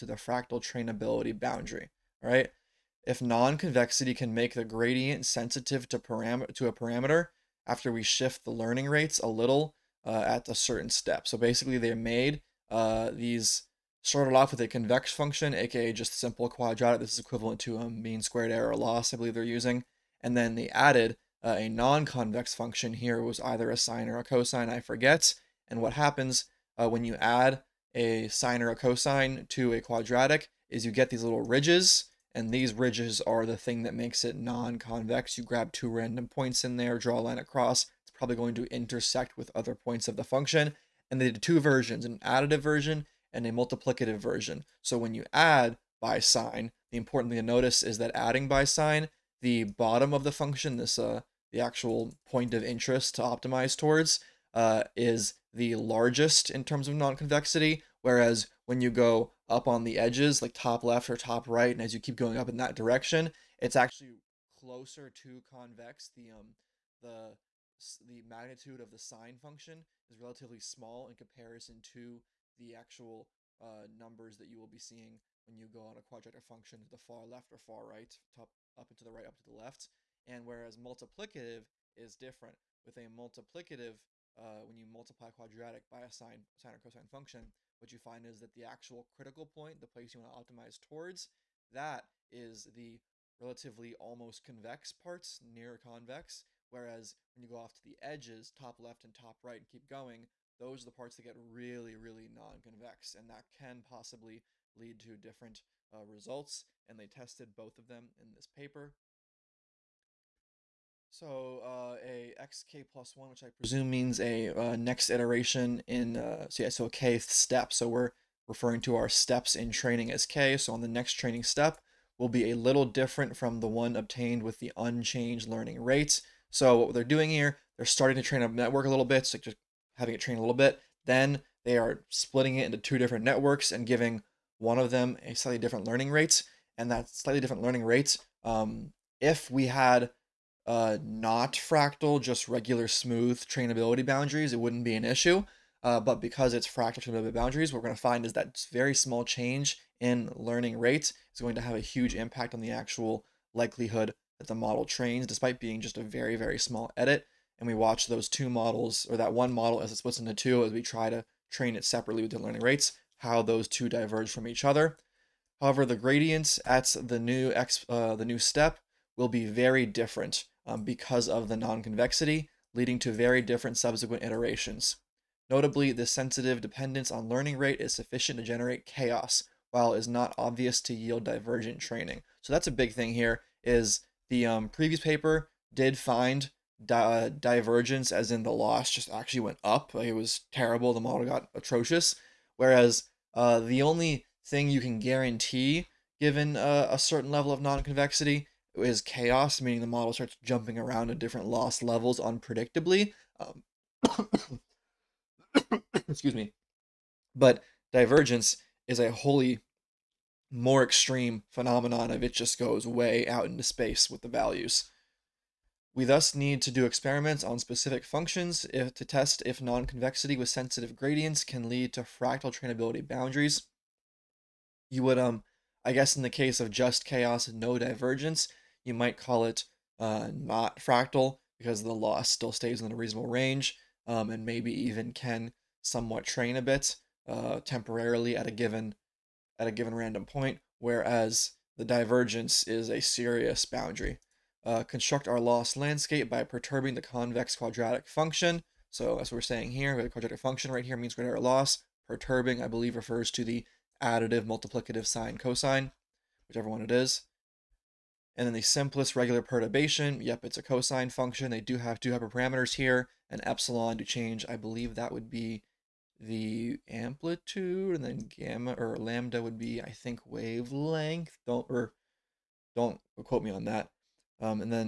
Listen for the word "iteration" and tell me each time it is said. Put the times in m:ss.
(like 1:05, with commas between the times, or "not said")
1:55, 2:54.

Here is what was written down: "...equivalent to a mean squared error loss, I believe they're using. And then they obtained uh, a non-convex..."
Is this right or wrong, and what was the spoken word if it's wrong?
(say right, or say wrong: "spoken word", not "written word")
wrong: "added", not "obtained".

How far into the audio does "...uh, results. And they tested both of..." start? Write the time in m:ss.
1:45.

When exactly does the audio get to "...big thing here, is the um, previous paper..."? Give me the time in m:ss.
3:02.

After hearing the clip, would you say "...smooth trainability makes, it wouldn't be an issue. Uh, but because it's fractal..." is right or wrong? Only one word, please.
wrong.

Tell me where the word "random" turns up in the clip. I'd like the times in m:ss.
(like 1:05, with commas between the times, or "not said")
0:35, 3:59.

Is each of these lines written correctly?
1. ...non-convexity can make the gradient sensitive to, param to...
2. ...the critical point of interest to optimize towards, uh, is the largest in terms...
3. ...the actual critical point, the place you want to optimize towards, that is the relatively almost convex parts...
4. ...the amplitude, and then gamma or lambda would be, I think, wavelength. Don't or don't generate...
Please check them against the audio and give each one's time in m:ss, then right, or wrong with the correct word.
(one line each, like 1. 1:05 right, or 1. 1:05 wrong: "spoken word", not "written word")
1. 0:03 right
2. 0:51 wrong: "actual", not "critical"
3. 1:28 right
4. 4:26 wrong: "quote", not "generate".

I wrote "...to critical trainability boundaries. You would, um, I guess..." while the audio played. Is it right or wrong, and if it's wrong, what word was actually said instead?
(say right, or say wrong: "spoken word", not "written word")
wrong: "fractal", not "critical".